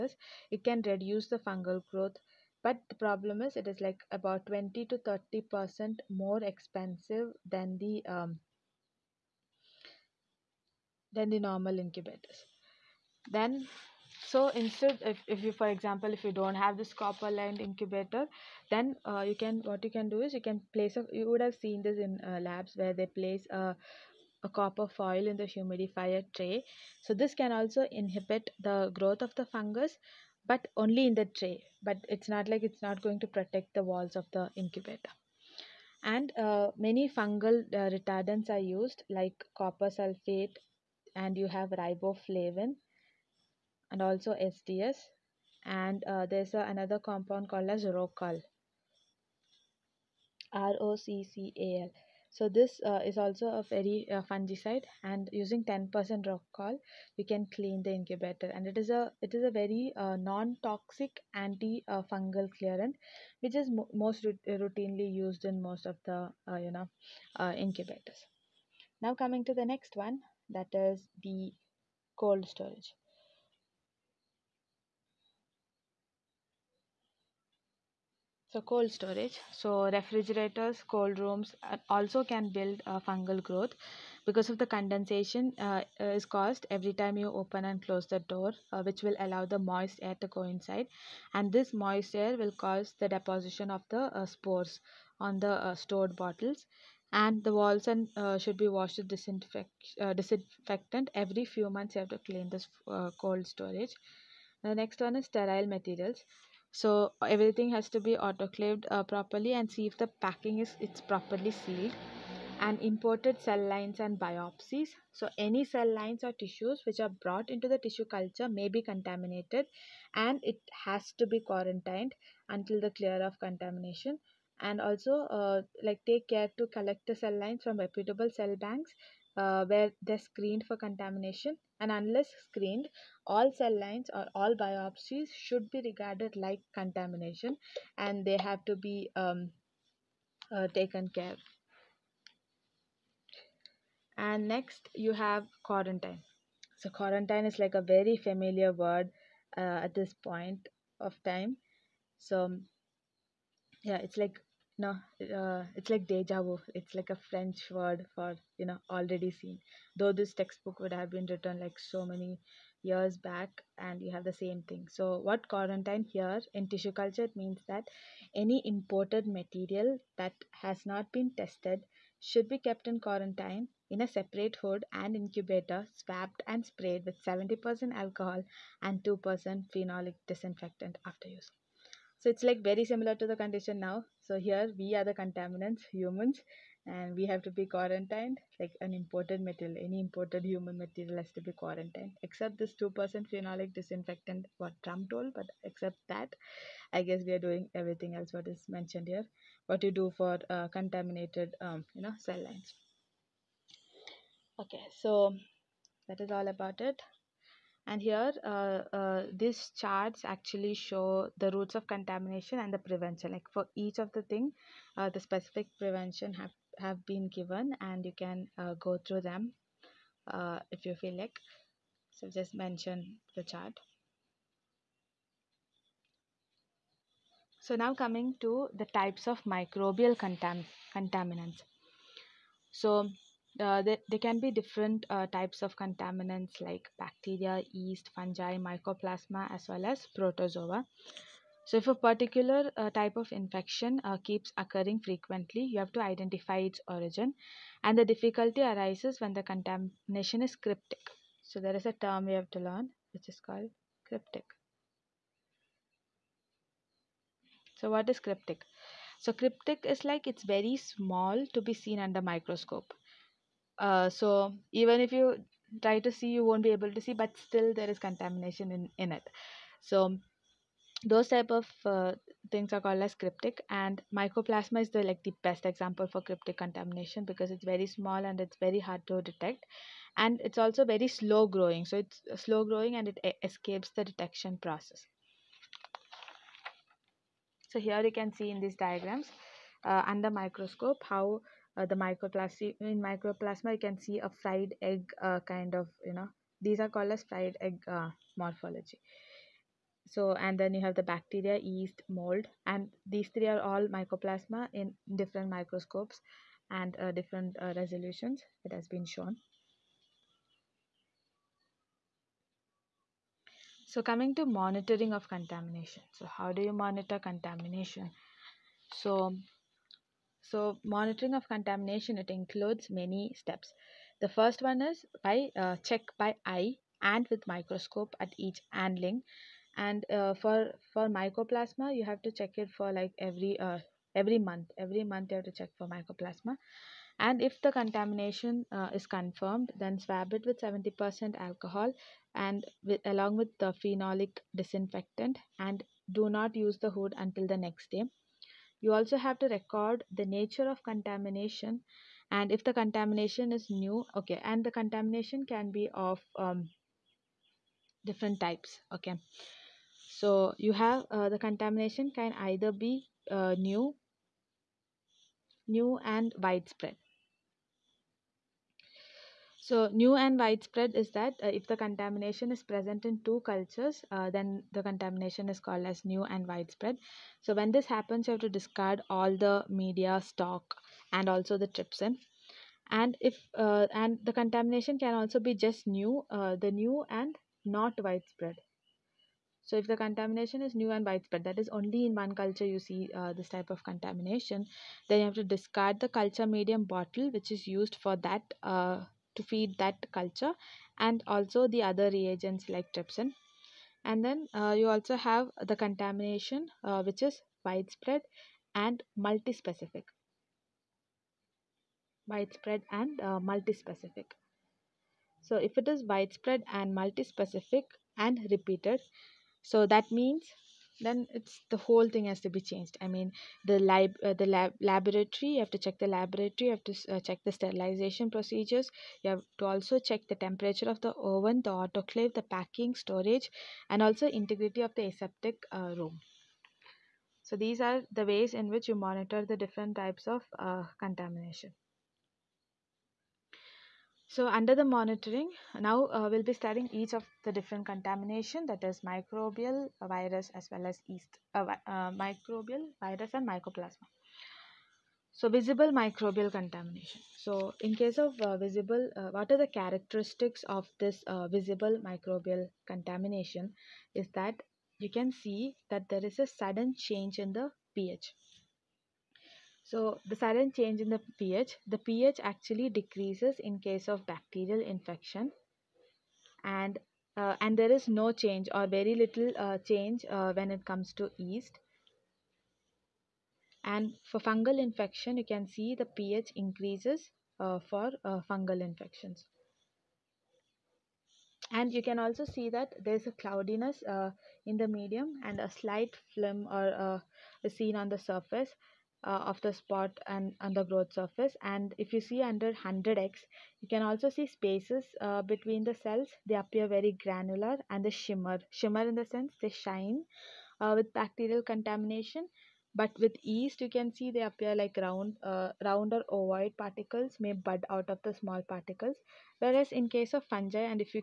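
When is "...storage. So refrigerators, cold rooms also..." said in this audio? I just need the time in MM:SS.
01:18.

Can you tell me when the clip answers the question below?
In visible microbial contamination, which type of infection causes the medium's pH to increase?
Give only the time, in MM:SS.
08:04.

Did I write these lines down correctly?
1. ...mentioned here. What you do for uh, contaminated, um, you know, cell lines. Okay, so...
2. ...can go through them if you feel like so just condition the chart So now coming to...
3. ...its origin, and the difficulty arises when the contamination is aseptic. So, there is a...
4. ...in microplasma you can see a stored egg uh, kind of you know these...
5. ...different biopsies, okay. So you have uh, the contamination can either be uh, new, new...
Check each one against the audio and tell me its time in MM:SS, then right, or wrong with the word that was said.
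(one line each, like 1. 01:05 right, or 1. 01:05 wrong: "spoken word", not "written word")
1. 03:18 right
2. 03:38 wrong: "mention", not "condition"
3. 04:06 wrong: "cryptic", not "aseptic"
4. 04:52 wrong: "fried", not "stored"
5. 05:58 wrong: "types", not "biopsies".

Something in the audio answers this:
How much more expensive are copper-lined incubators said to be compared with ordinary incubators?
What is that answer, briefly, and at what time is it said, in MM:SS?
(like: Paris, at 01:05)
20 to 30 percent, at 00:04.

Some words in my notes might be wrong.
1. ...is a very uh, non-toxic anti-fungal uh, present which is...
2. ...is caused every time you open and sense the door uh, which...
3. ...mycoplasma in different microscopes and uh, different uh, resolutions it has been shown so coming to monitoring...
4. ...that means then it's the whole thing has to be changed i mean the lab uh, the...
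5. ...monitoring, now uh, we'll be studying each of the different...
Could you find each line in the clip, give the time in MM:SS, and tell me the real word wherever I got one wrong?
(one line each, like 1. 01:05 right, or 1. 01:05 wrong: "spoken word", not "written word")
1. 00:59 wrong: "clearant", not "present"
2. 01:26 wrong: "close", not "sense"
3. 05:03 right
4. 06:59 right
5. 07:24 right.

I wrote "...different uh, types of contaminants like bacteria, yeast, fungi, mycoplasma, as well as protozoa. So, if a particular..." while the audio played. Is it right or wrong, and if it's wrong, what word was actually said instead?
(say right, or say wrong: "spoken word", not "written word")
right.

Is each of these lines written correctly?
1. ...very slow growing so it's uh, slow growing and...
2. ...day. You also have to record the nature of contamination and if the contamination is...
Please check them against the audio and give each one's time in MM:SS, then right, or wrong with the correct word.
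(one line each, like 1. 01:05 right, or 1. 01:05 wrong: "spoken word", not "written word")
1. 04:40 right
2. 05:47 right.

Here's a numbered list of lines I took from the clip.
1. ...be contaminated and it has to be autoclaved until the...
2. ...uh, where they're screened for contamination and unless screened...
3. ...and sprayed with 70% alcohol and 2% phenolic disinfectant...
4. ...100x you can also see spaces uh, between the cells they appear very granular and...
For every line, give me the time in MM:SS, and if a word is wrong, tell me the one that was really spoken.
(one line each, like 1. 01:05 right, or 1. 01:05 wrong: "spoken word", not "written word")
1. 01:58 wrong: "quarantined", not "autoclaved"
2. 02:09 right
3. 02:56 right
4. 08:22 right.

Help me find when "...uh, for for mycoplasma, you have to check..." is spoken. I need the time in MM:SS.
05:30.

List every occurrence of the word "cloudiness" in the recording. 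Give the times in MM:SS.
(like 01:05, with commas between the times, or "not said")
08:13.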